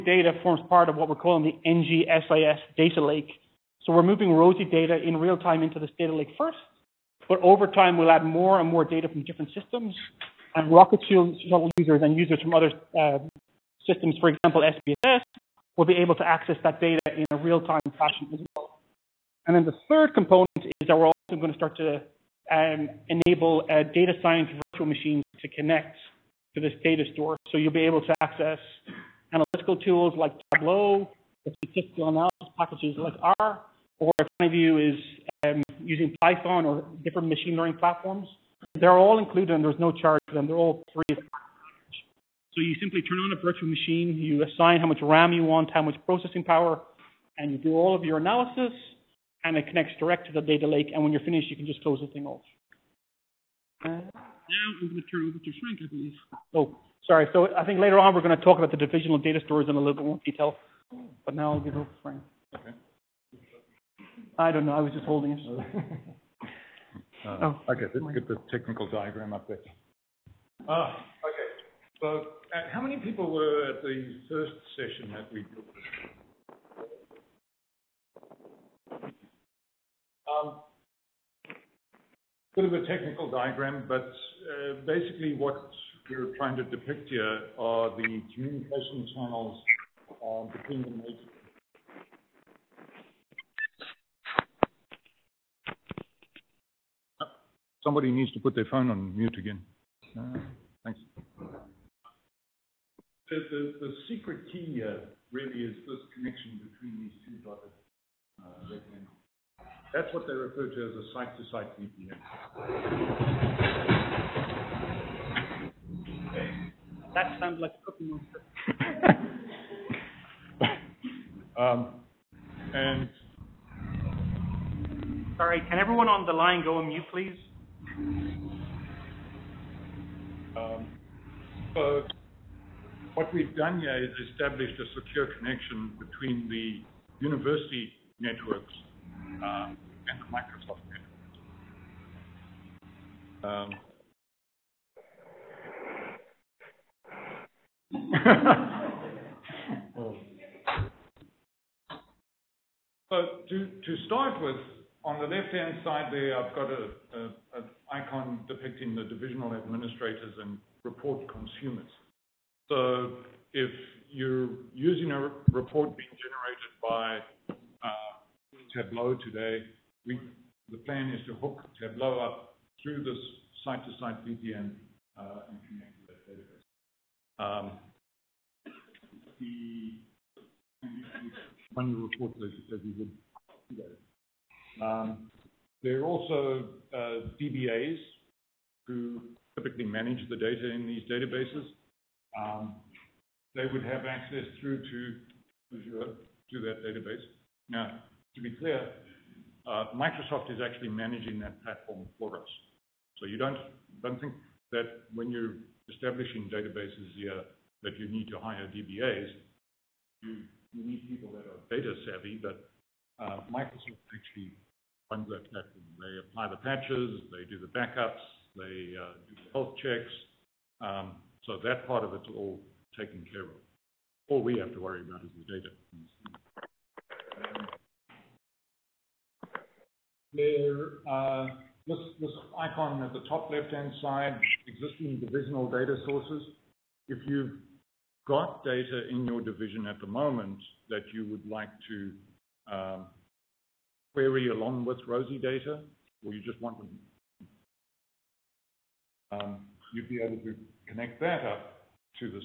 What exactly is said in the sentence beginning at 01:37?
Somebody needs to put their phone on mute again.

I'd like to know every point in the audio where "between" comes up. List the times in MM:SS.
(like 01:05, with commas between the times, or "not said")
01:30, 01:46, 02:15.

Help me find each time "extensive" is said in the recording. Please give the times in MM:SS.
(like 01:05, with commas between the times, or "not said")
not said.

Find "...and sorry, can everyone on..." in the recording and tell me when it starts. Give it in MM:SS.
02:02.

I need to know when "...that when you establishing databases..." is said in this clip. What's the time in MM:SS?
03:24.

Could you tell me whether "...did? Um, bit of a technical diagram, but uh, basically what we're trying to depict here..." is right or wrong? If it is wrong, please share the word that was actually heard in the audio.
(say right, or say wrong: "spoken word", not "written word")
right.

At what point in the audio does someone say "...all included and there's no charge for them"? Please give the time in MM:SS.
00:38.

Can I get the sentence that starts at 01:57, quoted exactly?
That sounds like a cookie monster.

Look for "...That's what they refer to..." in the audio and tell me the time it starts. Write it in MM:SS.
01:49.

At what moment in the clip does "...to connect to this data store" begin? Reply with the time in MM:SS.
00:25.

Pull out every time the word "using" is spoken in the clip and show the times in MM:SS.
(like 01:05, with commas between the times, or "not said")
00:35, 02:44.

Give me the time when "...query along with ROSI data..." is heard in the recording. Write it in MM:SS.
04:04.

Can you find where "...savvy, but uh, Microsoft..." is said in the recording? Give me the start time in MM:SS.
03:32.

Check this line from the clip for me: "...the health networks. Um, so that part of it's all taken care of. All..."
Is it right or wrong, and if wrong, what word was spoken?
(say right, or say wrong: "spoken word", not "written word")
wrong: "checks", not "networks".